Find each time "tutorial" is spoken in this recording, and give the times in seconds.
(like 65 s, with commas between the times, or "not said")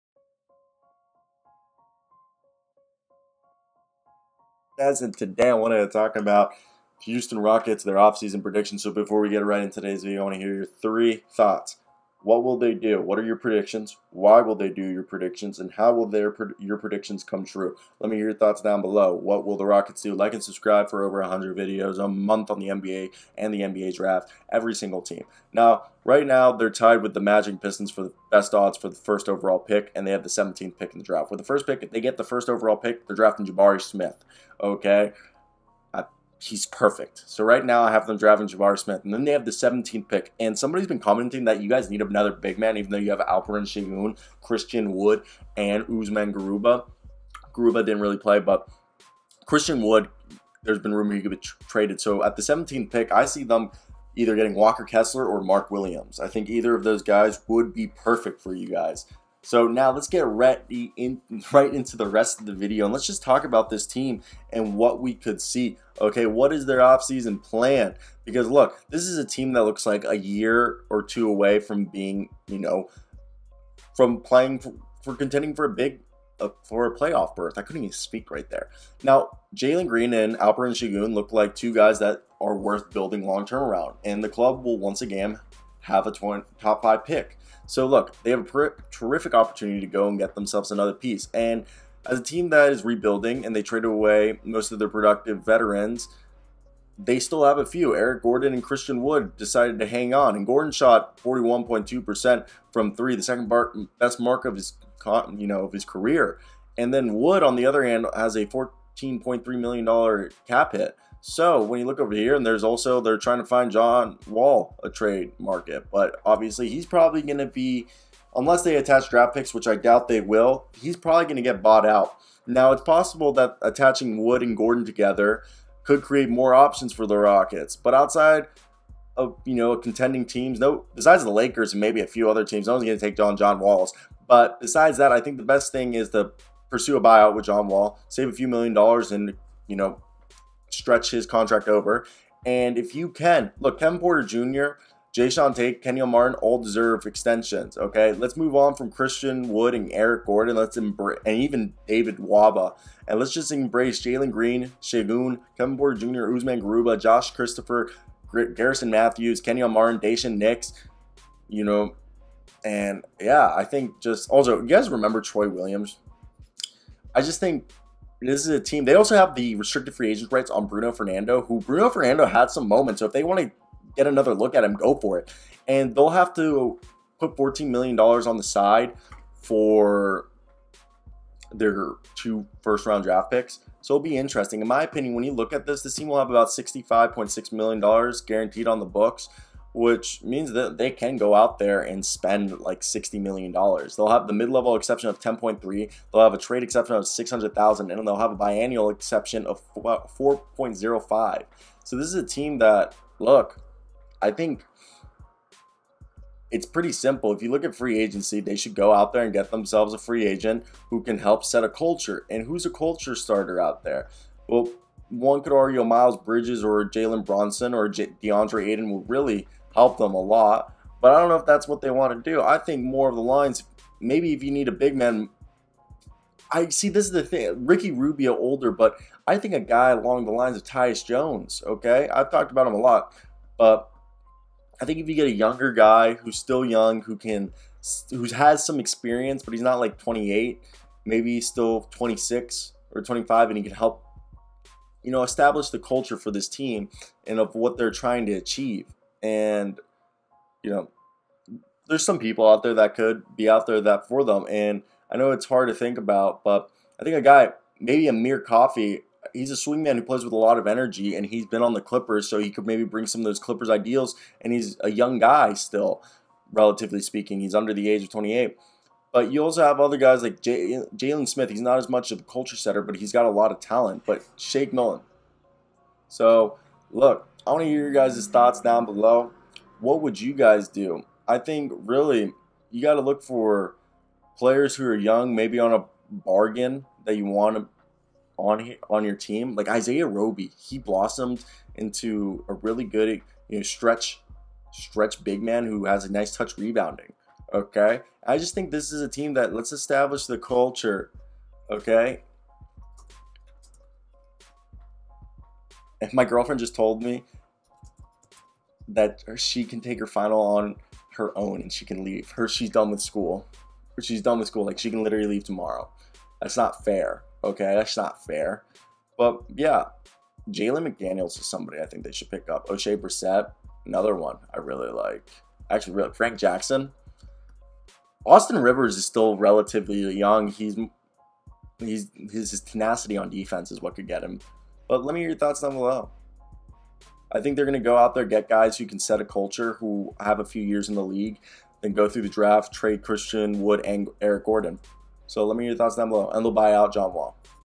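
not said.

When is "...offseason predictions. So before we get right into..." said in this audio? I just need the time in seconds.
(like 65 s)
7 s.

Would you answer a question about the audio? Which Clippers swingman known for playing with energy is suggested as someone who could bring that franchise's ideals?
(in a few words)
Amir Coffey.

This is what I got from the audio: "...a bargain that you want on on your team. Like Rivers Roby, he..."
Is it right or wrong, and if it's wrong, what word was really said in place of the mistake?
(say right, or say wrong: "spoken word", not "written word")
wrong: "Isaiah", not "Rivers".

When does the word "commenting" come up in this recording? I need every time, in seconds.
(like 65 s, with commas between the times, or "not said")
40 s.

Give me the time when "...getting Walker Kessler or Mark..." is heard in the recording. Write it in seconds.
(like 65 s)
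54 s.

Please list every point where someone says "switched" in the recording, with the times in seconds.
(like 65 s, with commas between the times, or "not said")
not said.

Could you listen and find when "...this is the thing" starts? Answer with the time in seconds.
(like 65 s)
226 s.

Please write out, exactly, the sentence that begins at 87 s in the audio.
So look, they have a terrific opportunity to go and get themselves another piece.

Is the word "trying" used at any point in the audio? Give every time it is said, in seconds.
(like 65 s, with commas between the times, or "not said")
113 s, 247 s.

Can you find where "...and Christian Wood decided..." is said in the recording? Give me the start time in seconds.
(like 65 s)
98 s.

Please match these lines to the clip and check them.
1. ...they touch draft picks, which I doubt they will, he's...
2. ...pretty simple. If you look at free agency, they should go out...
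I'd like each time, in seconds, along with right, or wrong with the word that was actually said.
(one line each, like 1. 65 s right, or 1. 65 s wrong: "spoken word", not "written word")
1. 118 s wrong: "attach", not "touch"
2. 206 s right.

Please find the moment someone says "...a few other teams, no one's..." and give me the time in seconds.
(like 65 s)
132 s.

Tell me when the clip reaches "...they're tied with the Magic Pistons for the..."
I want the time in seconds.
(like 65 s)
26 s.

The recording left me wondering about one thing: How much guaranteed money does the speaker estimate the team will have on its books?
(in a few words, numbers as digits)
$65.6 million.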